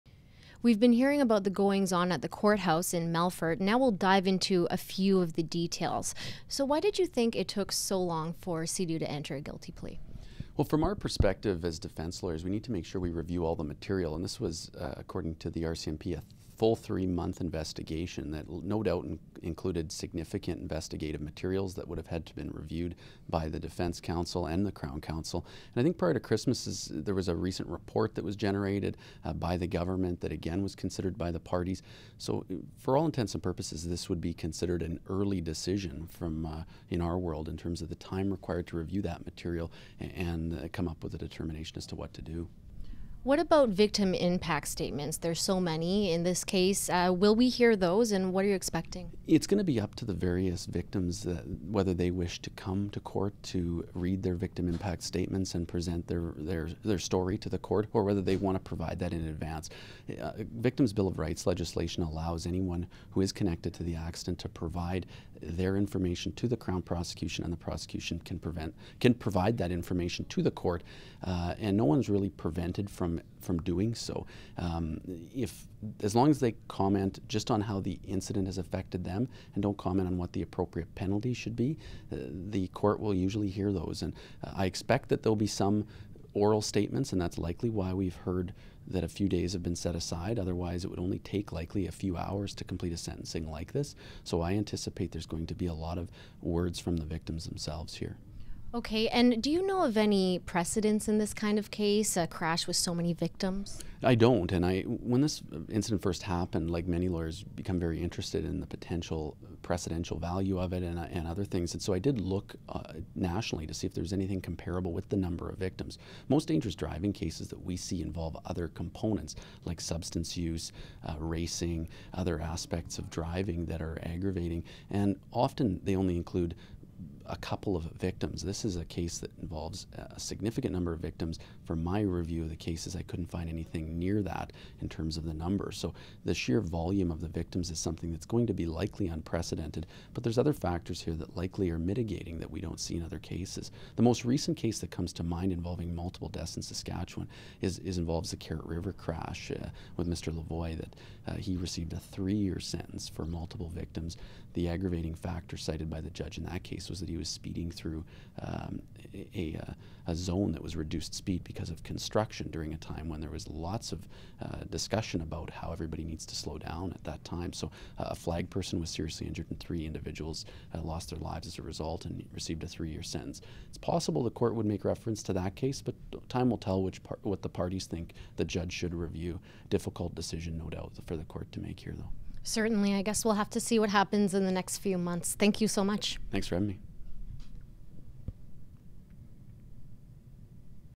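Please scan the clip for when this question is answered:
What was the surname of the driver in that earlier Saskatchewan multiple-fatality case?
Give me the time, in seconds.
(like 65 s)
150 s.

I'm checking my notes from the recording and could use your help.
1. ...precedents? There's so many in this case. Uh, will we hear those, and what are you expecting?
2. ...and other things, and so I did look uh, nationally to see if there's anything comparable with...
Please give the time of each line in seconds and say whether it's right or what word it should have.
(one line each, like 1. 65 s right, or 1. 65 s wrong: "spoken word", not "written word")
1. 44 s wrong: "statements", not "precedents"
2. 111 s right.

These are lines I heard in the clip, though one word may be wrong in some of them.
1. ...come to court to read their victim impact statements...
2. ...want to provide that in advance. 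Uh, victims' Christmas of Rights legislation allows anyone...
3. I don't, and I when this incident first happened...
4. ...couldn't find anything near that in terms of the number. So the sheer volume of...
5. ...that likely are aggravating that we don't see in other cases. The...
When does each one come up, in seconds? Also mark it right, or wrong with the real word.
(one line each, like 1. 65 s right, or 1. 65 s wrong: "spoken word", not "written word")
1. 52 s right
2. 58 s wrong: "Bill", not "Christmas"
3. 104 s right
4. 133 s right
5. 141 s wrong: "mitigating", not "aggravating".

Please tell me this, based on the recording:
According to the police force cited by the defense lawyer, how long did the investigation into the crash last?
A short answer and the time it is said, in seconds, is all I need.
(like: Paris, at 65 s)
3 months, at 16 s.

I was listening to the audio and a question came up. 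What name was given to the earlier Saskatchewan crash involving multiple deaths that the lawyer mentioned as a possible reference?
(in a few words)
Carrot River crash.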